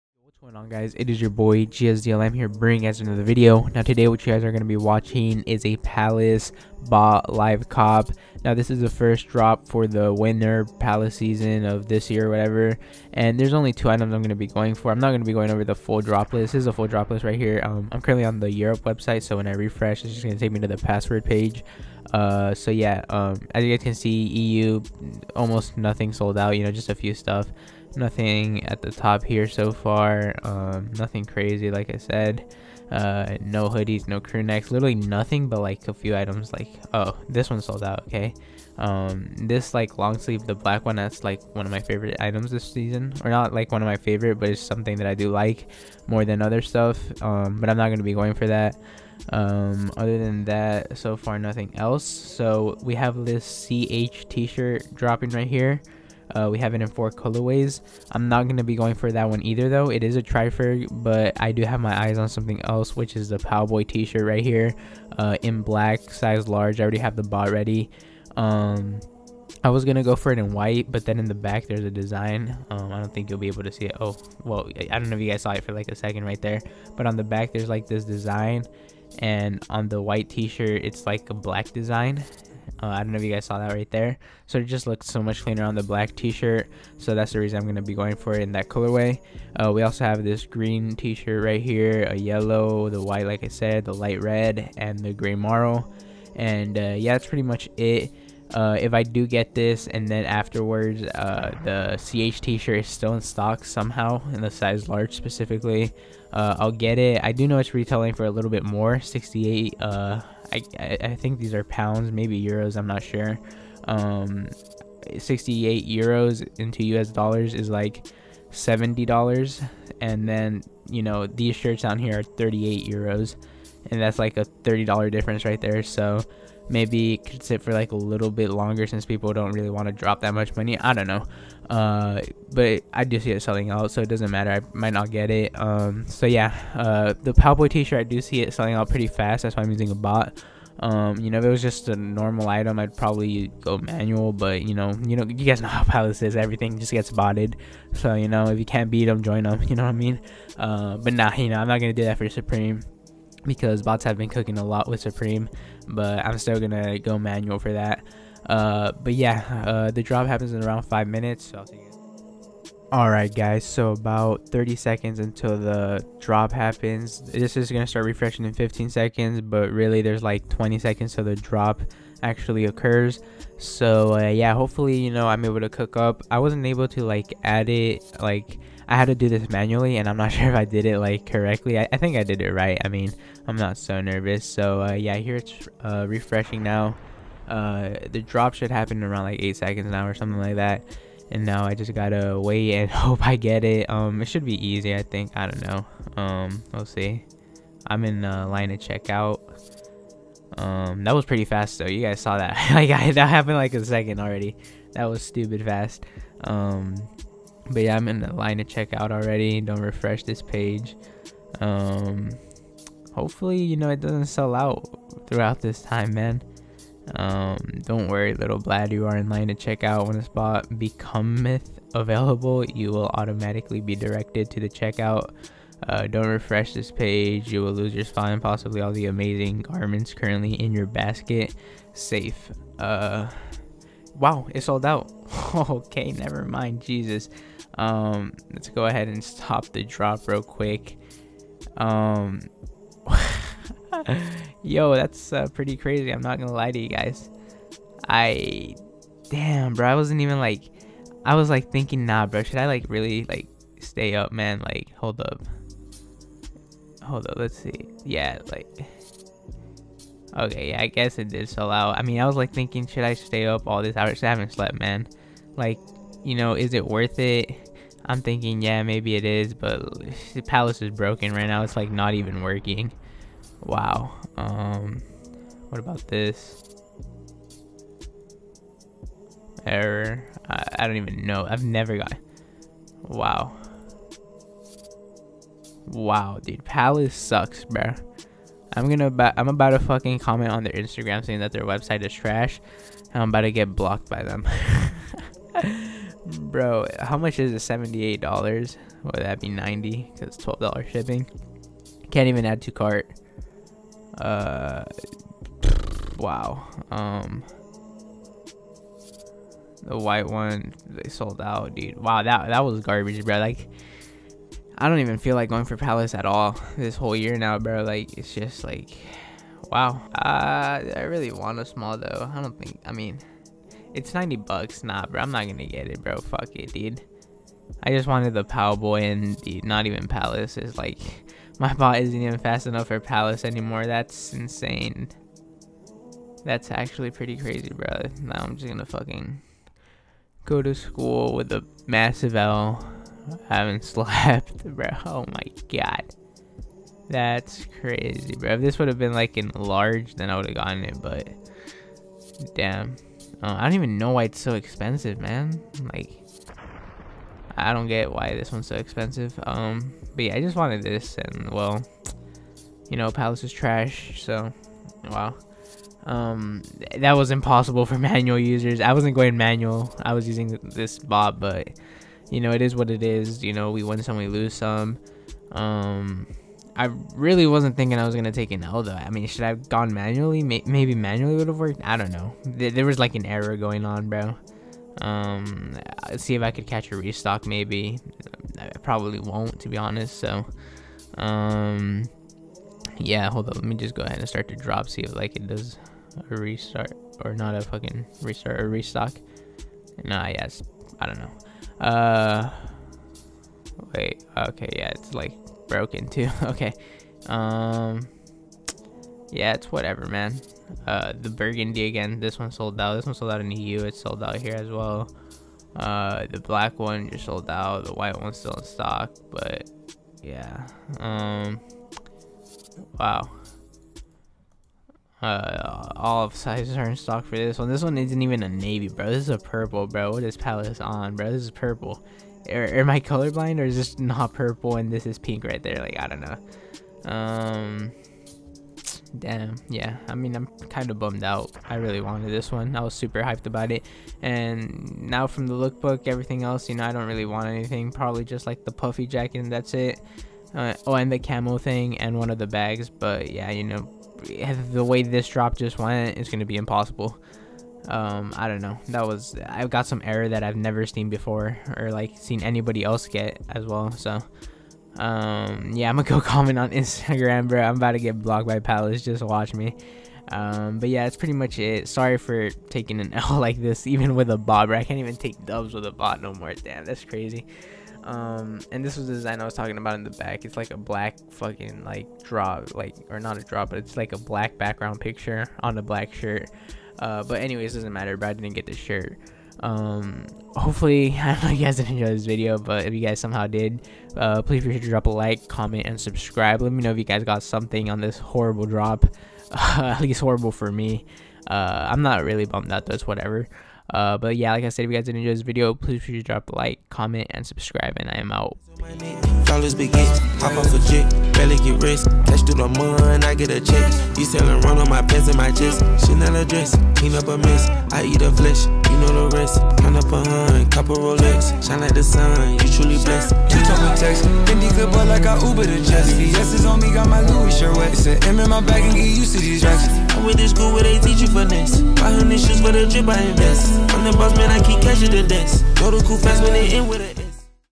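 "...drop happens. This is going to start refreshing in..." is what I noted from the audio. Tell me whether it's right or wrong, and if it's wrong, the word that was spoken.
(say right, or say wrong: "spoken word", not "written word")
right.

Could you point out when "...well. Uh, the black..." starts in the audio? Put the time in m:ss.
6:54.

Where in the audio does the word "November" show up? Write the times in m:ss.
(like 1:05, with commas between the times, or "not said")
not said.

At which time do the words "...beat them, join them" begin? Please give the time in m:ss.
2:28.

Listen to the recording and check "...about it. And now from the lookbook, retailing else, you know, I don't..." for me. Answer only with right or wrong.
wrong.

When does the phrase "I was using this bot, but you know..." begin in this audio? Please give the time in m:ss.
6:10.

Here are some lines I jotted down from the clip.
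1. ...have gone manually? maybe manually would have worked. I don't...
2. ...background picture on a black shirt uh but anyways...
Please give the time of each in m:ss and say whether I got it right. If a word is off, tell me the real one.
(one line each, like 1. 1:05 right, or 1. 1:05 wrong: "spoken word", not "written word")
1. 6:19 right
2. 8:04 right.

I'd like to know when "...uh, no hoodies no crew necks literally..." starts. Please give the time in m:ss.
0:32.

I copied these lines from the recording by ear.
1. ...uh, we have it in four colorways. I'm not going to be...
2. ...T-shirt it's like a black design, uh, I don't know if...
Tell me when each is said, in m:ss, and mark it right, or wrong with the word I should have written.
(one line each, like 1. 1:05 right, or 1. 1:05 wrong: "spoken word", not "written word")
1. 0:56 right
2. 1:20 right.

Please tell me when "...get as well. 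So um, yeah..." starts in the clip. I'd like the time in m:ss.
7:43.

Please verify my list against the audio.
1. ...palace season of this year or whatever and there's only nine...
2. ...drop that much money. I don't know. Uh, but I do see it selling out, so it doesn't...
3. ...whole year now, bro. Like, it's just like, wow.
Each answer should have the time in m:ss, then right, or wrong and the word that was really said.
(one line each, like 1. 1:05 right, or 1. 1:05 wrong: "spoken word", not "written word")
1. 0:10 wrong: "two", not "nine"
2. 2:09 right
3. 5:16 right.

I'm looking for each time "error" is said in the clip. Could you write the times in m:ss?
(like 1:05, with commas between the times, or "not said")
4:39, 6:23, 7:40.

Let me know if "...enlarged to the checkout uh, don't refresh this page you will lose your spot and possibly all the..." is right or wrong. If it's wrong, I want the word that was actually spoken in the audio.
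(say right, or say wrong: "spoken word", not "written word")
wrong: "directed", not "enlarged".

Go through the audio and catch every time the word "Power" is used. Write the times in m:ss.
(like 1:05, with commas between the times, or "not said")
5:28.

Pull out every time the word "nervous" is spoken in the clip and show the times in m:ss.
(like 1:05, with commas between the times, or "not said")
3:04.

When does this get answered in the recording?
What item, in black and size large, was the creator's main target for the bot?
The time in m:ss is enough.
1:03.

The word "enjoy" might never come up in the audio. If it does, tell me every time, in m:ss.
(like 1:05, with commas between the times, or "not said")
8:11, 8:25.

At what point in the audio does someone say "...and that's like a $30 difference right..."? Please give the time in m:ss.
2:03.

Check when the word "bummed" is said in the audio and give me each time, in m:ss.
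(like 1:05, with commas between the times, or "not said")
7:20, 8:22.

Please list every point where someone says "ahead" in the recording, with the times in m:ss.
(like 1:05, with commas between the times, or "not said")
3:58, 6:34.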